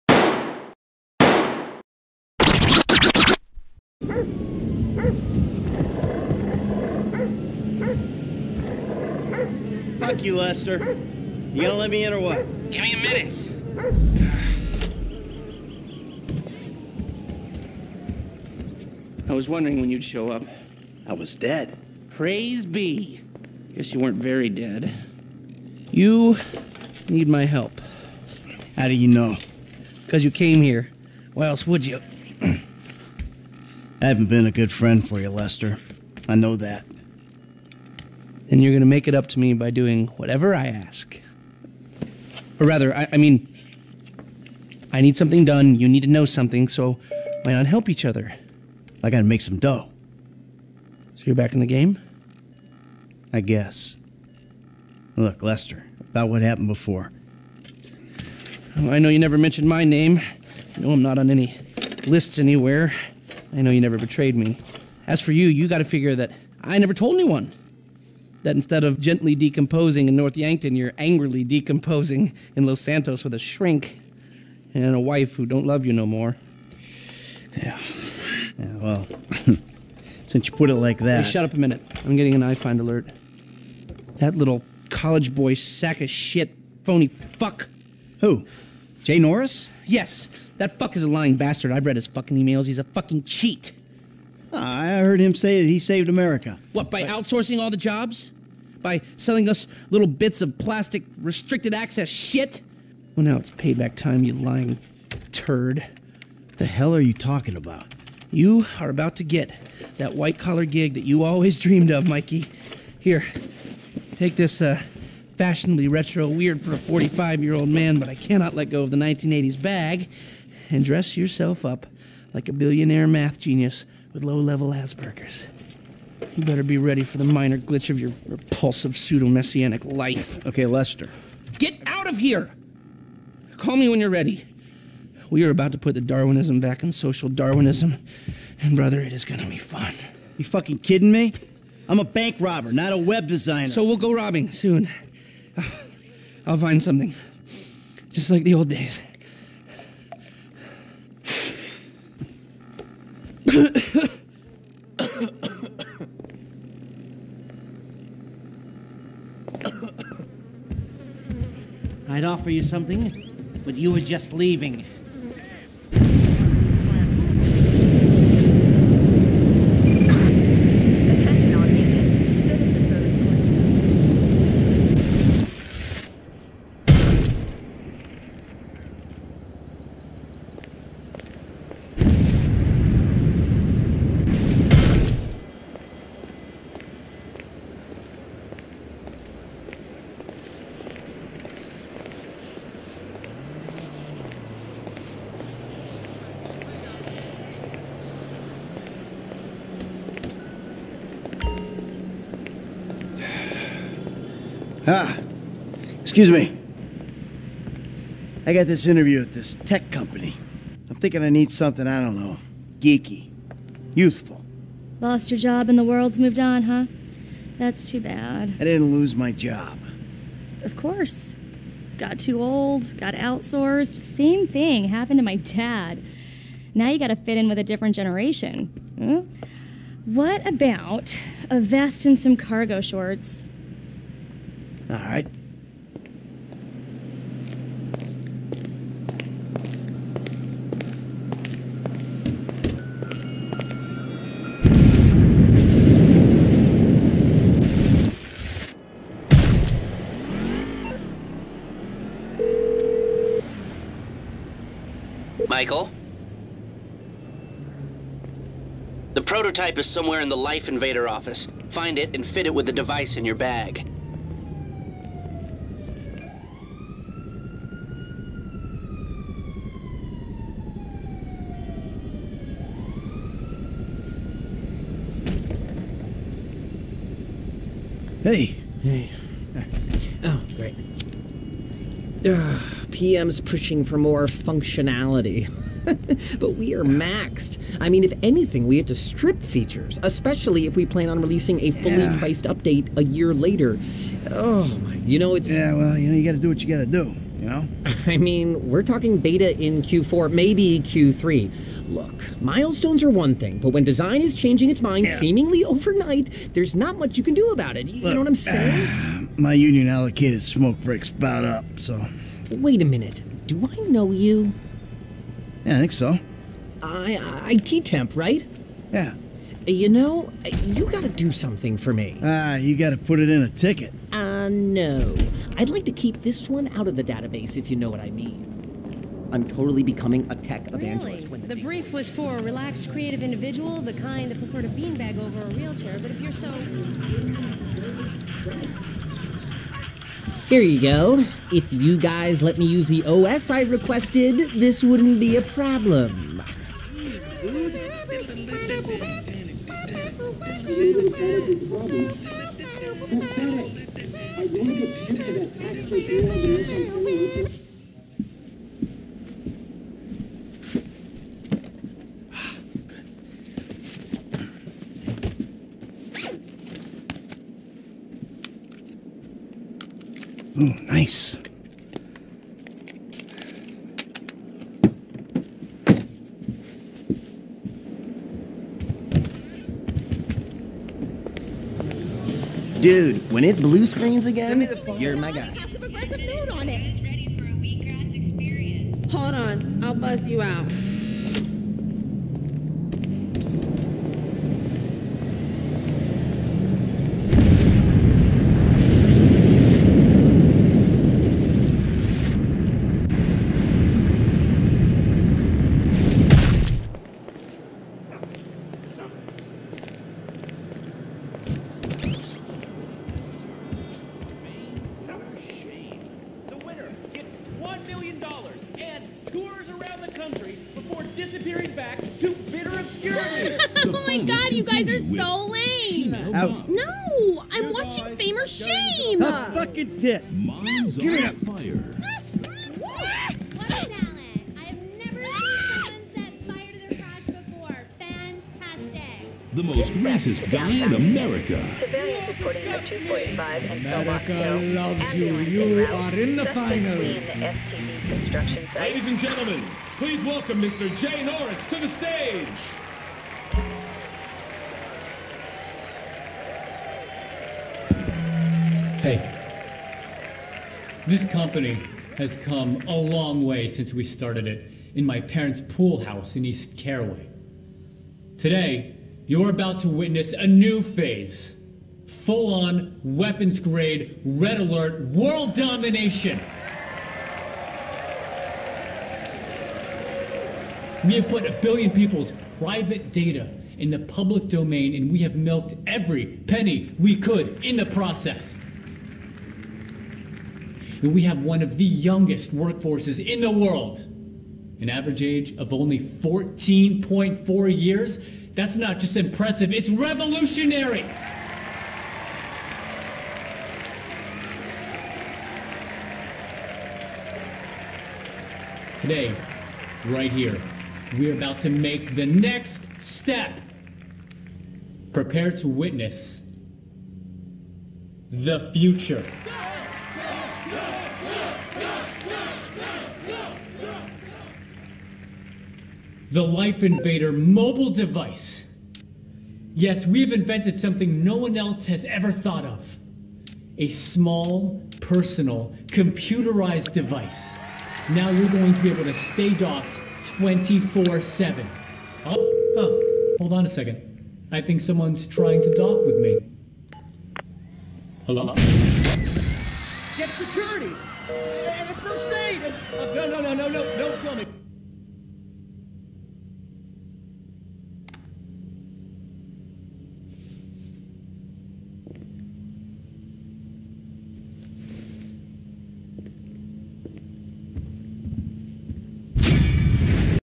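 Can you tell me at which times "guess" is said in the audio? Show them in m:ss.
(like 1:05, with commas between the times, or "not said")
0:23, 0:53.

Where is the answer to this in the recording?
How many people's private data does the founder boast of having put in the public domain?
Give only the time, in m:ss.
8:01.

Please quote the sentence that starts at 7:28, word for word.
Ladies and gentlemen, please welcome Mr.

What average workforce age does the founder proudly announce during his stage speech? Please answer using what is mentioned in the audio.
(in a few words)
14.4 years.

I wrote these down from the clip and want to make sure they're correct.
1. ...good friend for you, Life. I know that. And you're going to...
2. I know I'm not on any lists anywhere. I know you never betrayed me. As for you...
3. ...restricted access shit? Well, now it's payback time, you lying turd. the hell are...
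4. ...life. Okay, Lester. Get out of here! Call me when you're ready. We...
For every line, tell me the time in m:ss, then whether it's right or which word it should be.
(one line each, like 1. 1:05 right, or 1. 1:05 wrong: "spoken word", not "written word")
1. 0:34 wrong: "Lester", not "Life"
2. 1:00 right
3. 1:41 right
4. 2:09 right.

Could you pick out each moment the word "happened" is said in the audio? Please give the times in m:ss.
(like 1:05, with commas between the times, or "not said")
0:56, 3:44.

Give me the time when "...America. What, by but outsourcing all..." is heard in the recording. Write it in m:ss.
1:36.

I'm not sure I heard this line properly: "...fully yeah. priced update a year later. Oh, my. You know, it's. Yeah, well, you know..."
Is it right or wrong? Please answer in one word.
right.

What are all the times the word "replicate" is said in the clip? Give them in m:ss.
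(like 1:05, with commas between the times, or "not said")
not said.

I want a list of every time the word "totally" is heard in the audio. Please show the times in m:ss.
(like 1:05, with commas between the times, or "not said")
5:29.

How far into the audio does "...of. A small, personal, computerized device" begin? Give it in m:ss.
8:52.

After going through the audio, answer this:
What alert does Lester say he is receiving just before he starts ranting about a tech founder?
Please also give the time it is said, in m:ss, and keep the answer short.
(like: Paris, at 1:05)
iFind alert, at 1:22.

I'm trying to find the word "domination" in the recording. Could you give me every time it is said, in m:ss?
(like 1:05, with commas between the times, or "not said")
7:55.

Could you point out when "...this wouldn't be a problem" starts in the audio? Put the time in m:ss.
5:44.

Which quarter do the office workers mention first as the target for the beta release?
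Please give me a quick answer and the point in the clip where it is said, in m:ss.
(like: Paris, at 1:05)
Q4, at 4:59.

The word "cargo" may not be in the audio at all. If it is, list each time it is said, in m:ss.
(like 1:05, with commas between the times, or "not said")
3:52.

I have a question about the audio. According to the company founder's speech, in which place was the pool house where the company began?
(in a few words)
East Caraway.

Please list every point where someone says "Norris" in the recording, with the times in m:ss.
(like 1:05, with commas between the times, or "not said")
1:29, 7:31.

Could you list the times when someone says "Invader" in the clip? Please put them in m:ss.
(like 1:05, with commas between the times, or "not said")
4:20, 8:46.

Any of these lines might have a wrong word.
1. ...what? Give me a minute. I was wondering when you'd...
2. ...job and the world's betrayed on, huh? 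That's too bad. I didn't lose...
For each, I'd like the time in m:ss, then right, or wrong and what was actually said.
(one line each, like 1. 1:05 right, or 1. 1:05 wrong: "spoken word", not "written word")
1. 0:12 right
2. 3:35 wrong: "moved", not "betrayed".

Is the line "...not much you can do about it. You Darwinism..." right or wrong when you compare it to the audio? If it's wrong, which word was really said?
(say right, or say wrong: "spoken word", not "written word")
wrong: "Look", not "Darwinism".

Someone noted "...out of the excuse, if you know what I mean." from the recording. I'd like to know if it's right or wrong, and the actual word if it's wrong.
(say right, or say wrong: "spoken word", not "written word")
wrong: "database", not "excuse".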